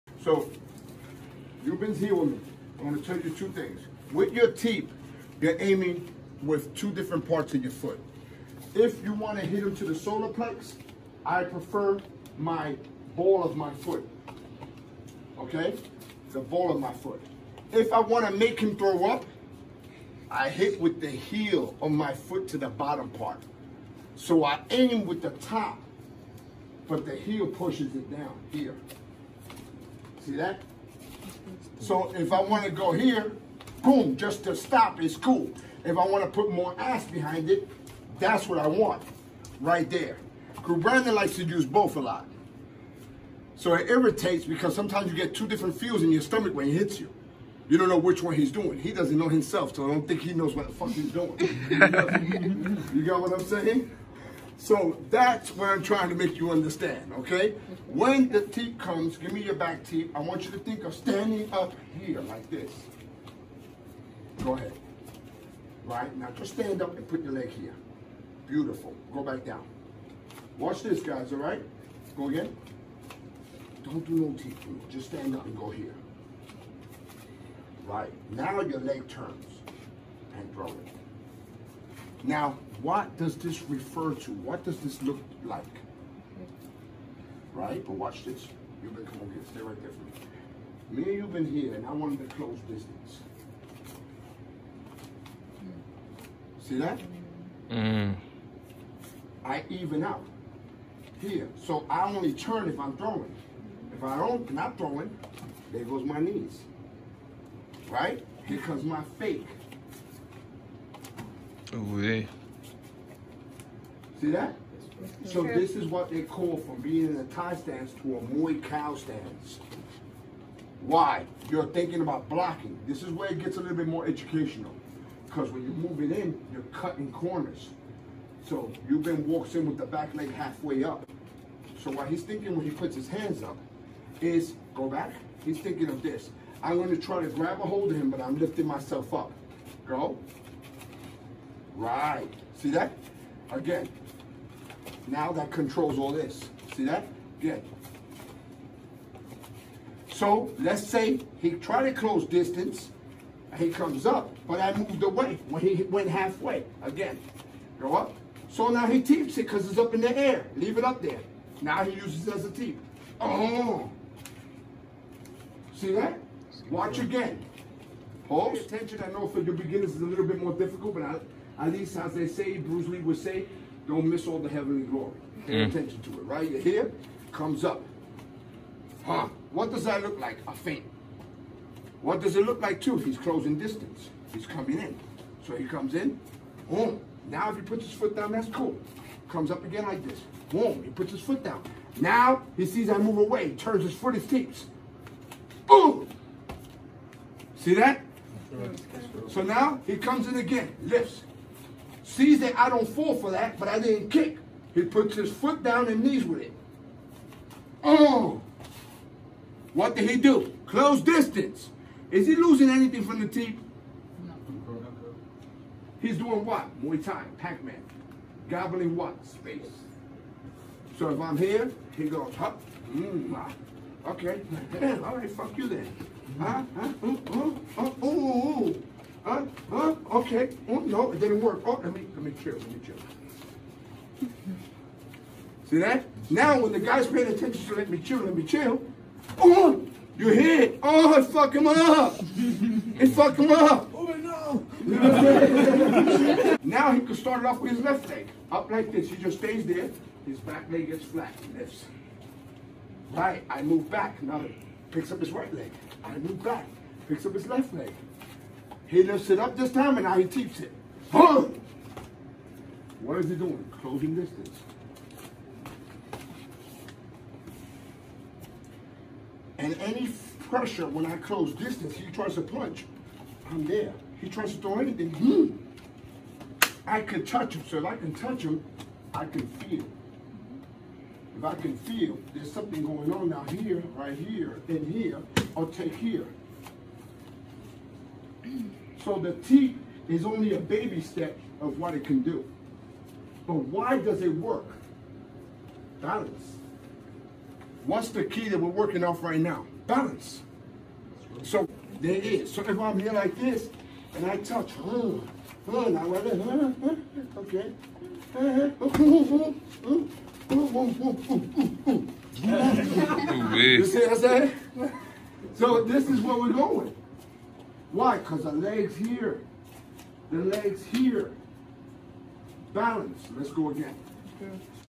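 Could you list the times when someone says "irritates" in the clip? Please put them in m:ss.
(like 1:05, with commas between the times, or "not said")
0:43.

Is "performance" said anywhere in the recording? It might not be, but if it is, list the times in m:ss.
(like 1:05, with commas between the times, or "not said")
not said.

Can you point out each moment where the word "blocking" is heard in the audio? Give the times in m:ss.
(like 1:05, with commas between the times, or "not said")
2:02.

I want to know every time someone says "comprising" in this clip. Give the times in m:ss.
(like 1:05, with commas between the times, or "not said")
not said.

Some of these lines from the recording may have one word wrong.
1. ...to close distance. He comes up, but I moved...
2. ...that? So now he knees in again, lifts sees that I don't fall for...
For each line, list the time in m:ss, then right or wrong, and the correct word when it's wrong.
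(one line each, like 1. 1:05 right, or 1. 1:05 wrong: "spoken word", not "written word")
1. 2:31 right
2. 3:17 wrong: "comes", not "knees".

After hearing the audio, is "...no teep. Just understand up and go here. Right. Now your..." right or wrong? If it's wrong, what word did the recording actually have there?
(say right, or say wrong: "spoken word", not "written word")
wrong: "stand", not "understand".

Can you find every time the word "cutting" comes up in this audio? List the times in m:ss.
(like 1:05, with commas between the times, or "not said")
2:06.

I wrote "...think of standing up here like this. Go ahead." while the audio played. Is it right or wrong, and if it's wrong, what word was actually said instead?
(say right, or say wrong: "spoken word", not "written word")
right.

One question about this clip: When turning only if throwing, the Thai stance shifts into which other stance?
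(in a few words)
Muay Khao stance.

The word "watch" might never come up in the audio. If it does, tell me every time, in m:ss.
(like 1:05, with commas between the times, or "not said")
1:10, 1:27, 2:46.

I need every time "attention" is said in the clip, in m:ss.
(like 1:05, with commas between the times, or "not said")
2:48, 2:55, 3:57.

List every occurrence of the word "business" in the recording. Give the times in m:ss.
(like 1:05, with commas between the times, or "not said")
1:32.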